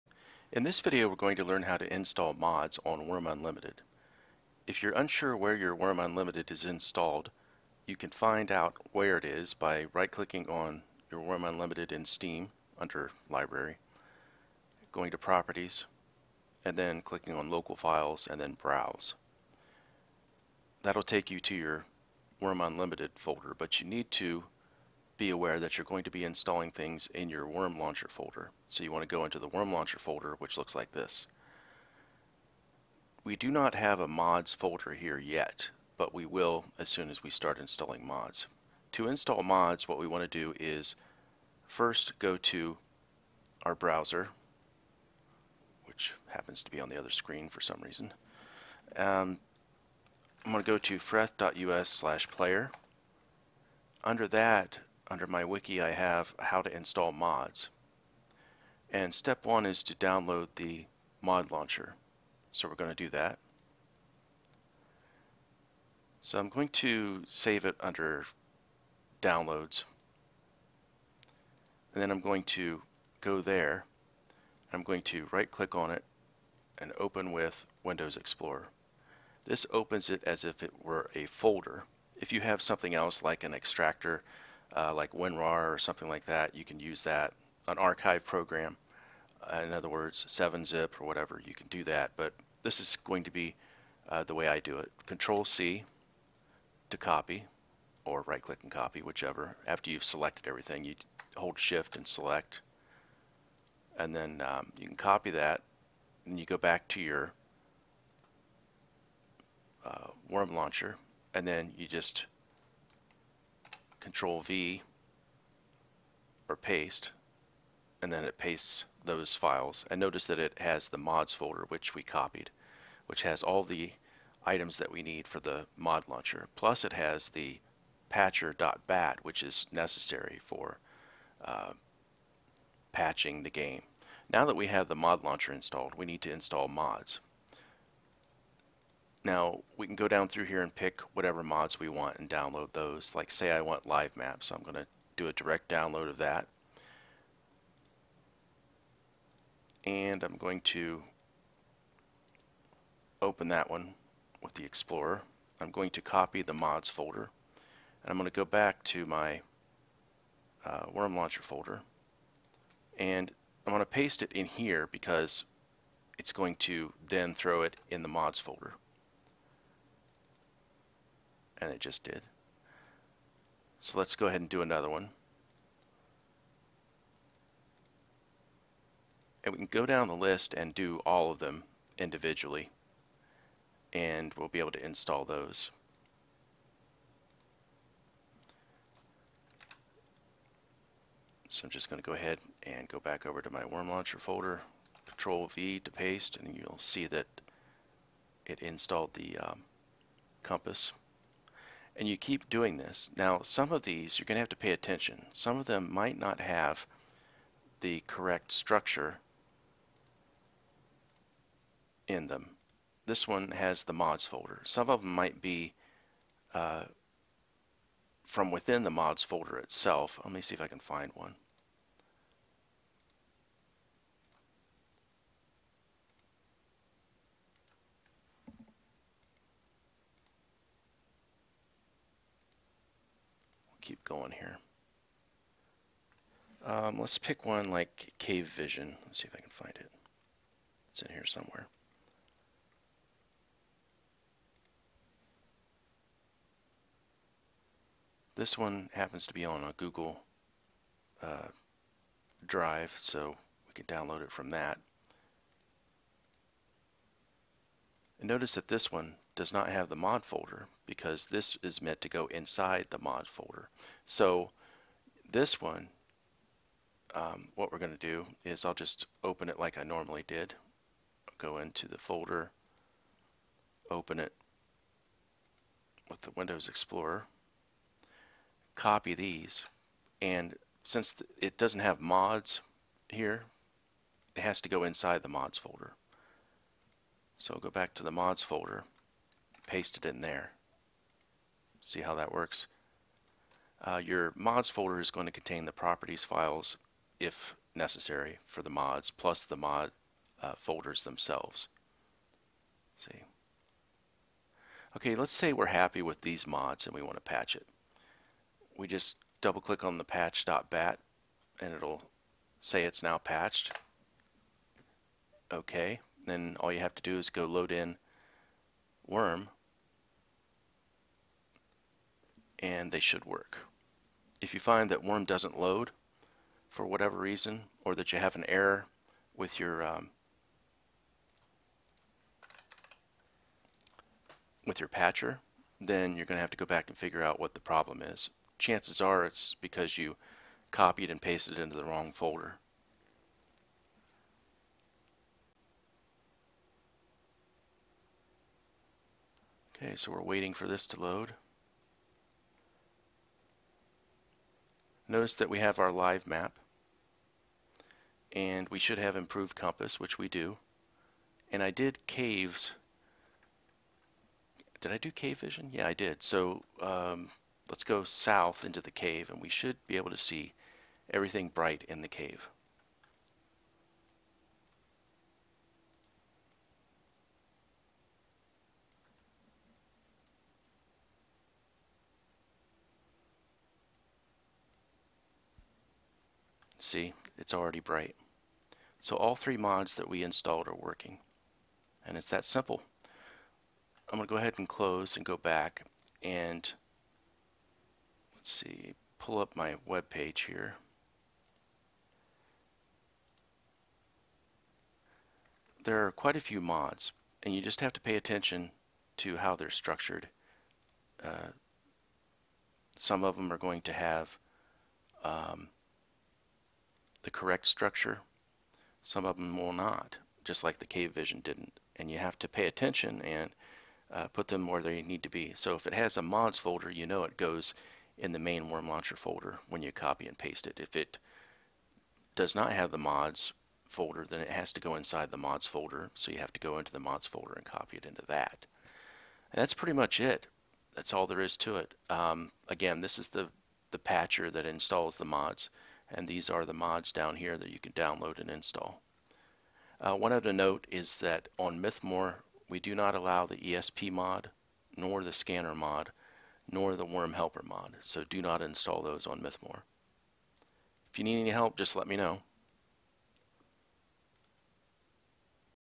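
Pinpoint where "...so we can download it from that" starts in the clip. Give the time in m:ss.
4:12.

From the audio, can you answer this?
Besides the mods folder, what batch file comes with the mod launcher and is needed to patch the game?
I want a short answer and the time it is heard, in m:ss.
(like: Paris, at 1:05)
patcher.bat, at 2:08.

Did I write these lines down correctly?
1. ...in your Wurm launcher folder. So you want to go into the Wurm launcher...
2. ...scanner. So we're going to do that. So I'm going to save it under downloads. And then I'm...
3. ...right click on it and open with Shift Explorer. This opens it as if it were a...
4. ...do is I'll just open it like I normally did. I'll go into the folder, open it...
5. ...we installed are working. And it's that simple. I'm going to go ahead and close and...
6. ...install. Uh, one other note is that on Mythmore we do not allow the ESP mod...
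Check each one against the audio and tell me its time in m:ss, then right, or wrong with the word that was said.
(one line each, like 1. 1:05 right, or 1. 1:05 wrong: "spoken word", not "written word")
1. 0:27 right
2. 1:01 wrong: "launcher", not "scanner"
3. 1:15 wrong: "Windows", not "Shift"
4. 4:27 right
5. 6:30 right
6. 7:28 right.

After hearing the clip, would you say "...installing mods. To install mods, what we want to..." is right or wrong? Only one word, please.
right.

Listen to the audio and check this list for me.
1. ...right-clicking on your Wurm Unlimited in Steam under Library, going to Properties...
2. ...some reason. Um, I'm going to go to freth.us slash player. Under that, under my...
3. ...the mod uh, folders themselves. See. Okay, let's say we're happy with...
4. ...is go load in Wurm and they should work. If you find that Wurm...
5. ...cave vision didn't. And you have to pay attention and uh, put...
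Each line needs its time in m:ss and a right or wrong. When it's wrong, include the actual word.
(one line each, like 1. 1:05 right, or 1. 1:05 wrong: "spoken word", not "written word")
1. 0:09 right
2. 0:47 right
3. 4:59 right
4. 5:17 right
5. 7:00 right.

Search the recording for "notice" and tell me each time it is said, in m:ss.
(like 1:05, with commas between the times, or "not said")
1:59, 4:18, 5:55.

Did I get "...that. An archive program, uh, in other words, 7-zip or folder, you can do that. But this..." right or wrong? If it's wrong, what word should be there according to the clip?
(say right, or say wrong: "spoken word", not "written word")
wrong: "whatever", not "folder".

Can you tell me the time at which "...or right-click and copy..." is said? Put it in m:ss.
1:38.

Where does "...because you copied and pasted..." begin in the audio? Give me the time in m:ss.
5:39.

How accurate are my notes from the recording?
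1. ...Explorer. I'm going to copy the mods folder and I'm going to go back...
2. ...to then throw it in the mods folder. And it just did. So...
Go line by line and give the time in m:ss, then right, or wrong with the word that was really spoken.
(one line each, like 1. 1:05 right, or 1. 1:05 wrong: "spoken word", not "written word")
1. 2:34 right
2. 2:46 right.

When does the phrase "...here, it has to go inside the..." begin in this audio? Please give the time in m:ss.
4:43.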